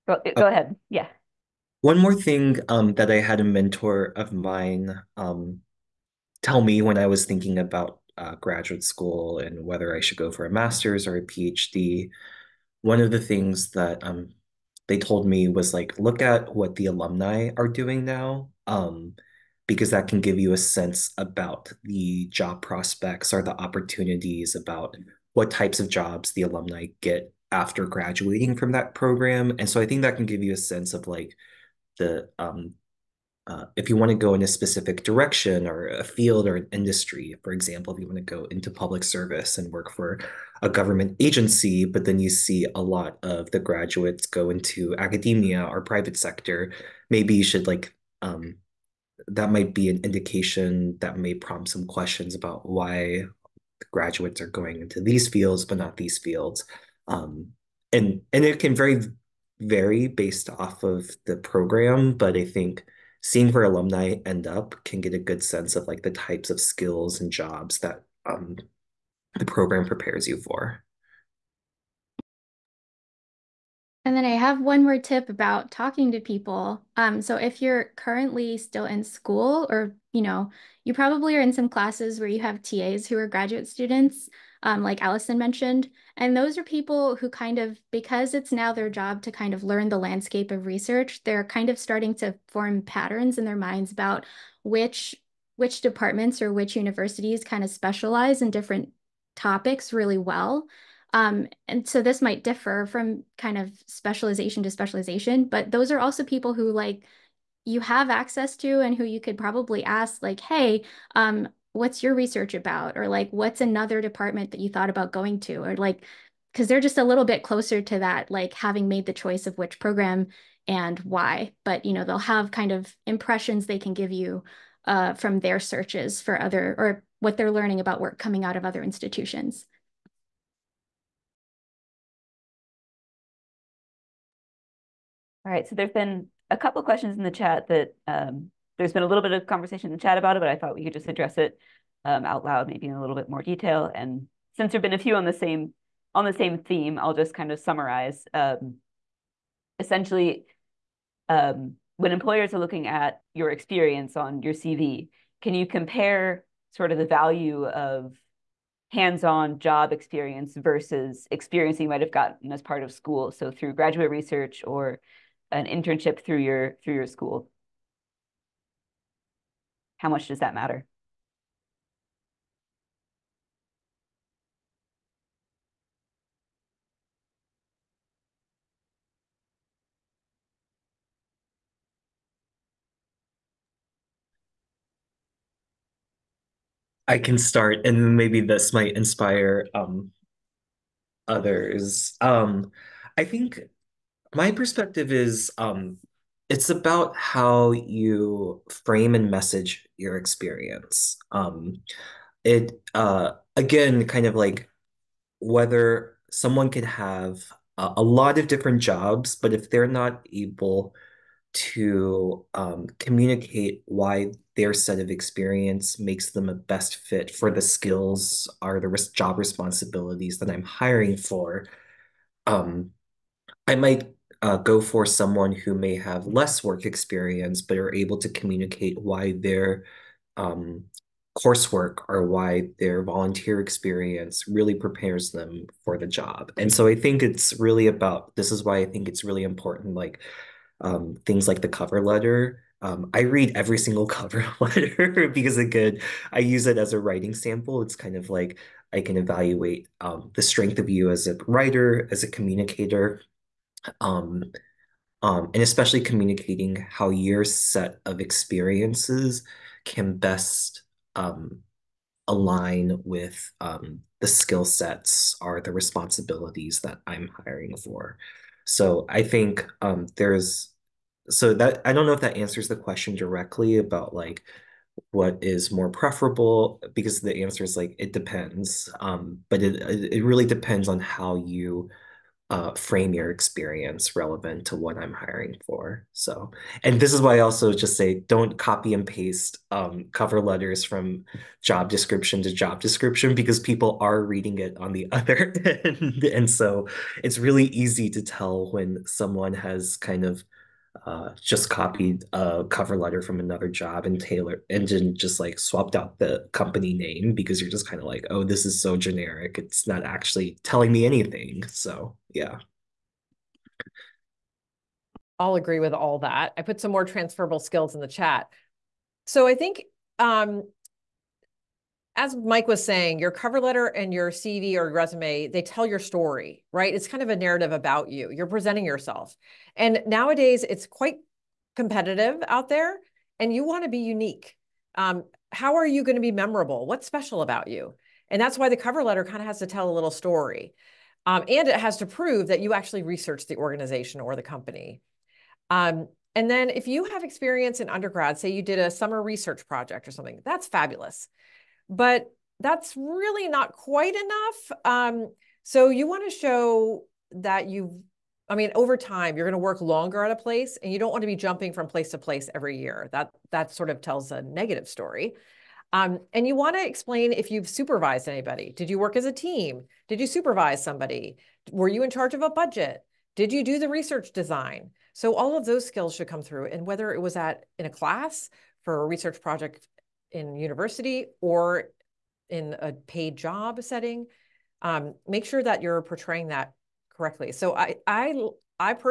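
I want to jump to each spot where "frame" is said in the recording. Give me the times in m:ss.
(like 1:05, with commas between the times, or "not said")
3:18, 4:42.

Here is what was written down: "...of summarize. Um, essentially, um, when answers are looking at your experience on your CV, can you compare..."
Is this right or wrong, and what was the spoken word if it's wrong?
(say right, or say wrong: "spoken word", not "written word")
wrong: "employers", not "answers".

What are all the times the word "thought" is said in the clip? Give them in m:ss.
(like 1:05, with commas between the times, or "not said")
1:54, 2:20.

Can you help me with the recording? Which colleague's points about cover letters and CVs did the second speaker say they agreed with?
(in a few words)
Mike.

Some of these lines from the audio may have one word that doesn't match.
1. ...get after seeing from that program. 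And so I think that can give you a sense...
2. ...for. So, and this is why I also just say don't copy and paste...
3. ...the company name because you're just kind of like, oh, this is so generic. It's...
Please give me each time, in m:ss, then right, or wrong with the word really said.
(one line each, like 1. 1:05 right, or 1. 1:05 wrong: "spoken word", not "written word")
1. 0:27 wrong: "graduating", not "seeing"
2. 4:45 right
3. 5:06 right.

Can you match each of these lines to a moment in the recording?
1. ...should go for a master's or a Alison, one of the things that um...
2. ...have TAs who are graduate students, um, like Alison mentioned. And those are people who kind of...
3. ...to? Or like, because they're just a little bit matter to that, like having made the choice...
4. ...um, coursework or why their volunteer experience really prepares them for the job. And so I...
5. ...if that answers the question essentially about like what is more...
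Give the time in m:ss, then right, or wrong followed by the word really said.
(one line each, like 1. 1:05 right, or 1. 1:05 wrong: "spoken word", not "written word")
1. 0:09 wrong: "PhD", not "Alison"
2. 1:22 right
3. 1:55 wrong: "closer", not "matter"
4. 3:50 right
5. 4:32 wrong: "directly", not "essentially".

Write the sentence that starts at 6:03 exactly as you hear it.
That, that sort of tells a negative story.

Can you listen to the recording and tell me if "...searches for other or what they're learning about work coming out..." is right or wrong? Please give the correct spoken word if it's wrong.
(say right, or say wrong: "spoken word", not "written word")
right.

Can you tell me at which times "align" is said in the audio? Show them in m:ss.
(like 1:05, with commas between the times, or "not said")
4:22.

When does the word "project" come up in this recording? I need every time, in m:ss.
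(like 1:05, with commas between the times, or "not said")
5:49, 6:19.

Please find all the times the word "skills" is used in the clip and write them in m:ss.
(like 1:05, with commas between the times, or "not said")
1:06, 3:37, 4:24, 5:17, 6:15.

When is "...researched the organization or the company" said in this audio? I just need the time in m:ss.
5:43.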